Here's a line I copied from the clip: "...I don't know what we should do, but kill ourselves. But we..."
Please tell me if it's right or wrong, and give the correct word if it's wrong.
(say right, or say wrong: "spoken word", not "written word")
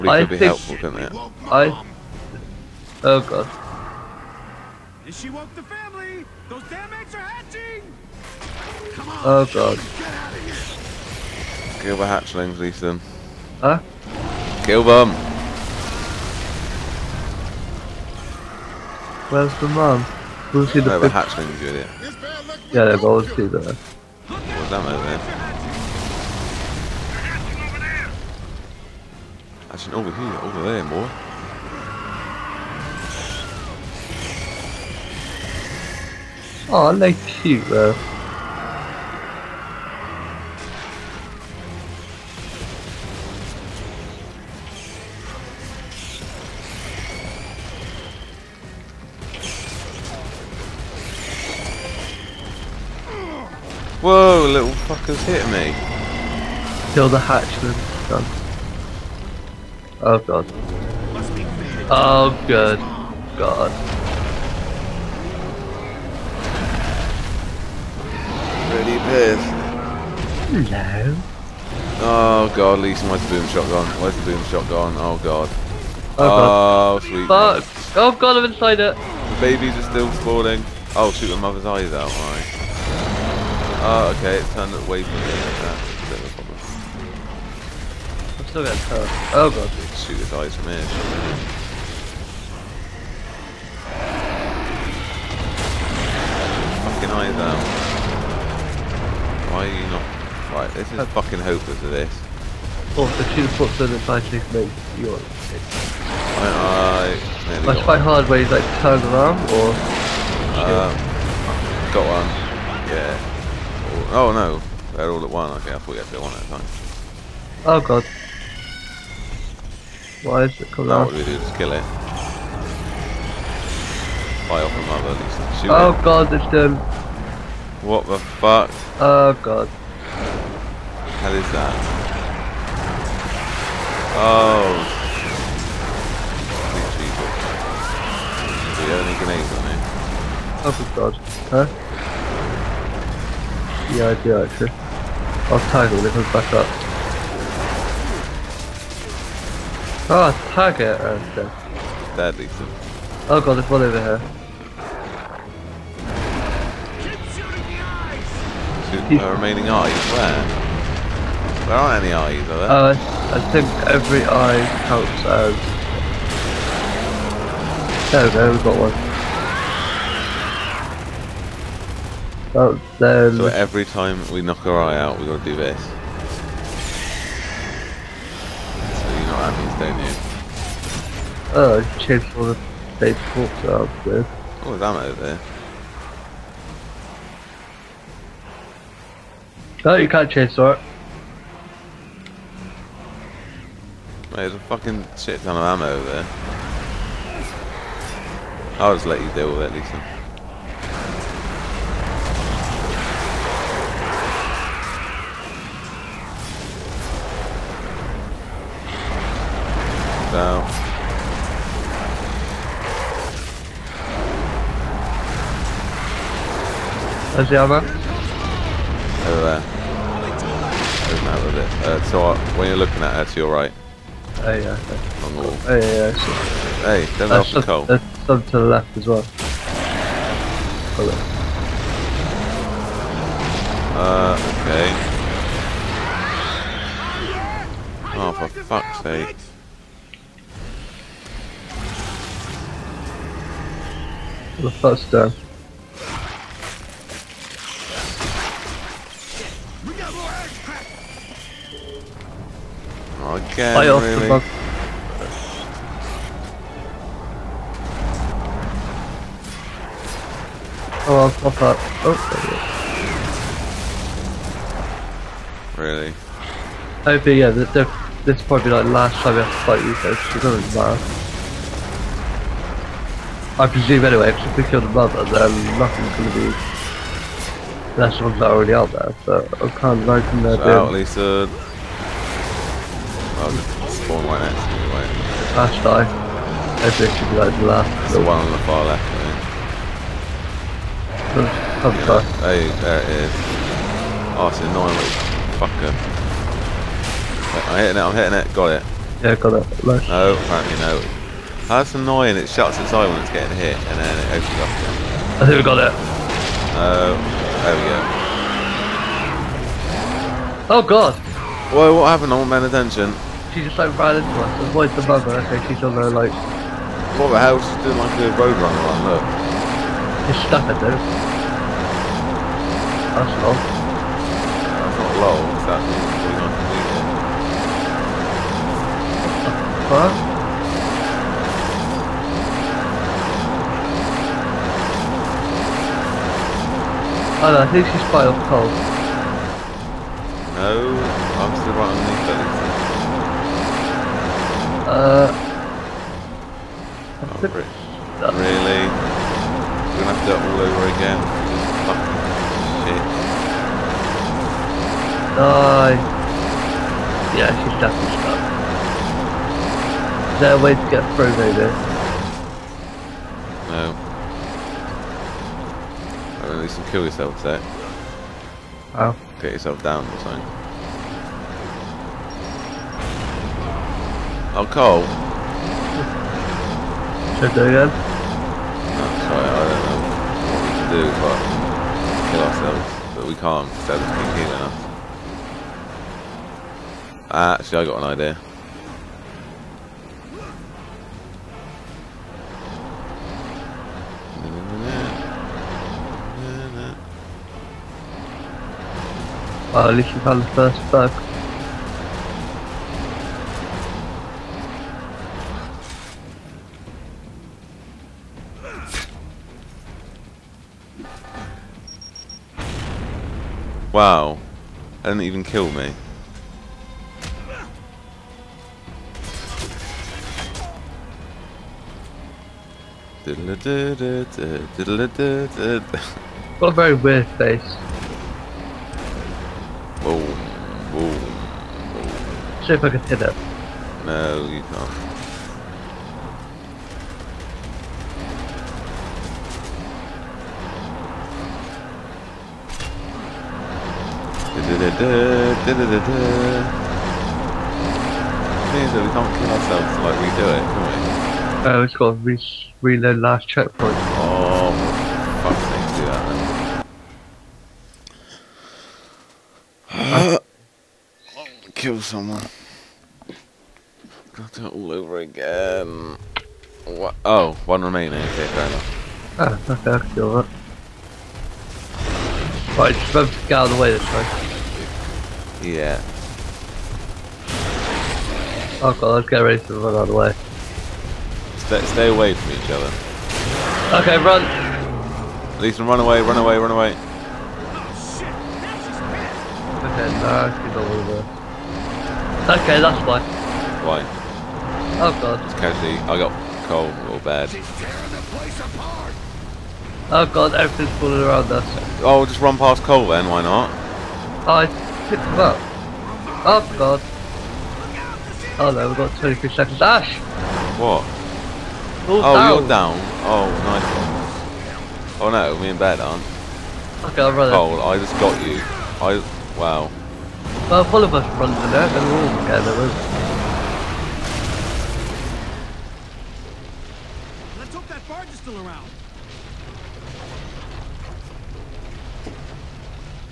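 right.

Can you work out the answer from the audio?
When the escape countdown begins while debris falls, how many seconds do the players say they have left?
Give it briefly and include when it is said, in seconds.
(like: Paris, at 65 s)
23, at 509 s.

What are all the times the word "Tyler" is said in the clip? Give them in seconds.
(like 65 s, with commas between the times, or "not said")
337 s.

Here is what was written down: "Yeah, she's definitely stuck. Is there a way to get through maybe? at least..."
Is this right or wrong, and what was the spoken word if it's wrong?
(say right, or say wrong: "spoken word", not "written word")
right.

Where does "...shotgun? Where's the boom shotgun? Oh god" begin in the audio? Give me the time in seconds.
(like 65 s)
73 s.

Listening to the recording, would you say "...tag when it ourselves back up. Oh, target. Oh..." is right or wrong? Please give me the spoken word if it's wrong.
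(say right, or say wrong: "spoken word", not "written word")
wrong: "comes", not "ourselves".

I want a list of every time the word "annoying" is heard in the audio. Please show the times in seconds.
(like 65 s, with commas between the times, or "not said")
294 s, 301 s.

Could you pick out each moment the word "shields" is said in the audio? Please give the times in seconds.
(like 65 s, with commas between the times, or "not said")
not said.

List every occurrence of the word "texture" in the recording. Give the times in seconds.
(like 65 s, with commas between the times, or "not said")
not said.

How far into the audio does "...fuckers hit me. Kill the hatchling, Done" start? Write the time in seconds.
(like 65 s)
54 s.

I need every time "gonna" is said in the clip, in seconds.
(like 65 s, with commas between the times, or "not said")
349 s.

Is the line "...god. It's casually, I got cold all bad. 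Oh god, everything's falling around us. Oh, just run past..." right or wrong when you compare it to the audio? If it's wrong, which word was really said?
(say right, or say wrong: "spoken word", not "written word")
right.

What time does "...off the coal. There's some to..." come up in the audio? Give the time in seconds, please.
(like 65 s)
227 s.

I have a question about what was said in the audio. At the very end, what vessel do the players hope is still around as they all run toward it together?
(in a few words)
barge.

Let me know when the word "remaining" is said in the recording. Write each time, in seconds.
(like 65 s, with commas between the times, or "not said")
159 s, 467 s.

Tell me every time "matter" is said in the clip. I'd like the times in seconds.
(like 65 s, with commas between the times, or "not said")
270 s.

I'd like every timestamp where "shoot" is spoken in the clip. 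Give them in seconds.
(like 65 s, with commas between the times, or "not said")
81 s, 90 s, 125 s, 158 s.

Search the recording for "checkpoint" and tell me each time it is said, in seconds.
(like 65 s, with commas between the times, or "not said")
453 s.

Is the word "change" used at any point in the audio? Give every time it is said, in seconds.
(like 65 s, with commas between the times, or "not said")
181 s, 190 s.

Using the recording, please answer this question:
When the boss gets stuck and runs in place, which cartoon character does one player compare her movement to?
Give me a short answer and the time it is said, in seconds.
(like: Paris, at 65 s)
Roadrunner, at 318 s.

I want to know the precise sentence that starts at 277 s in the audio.
That's ones that already out there, so I'm kind of hoping they're so doing...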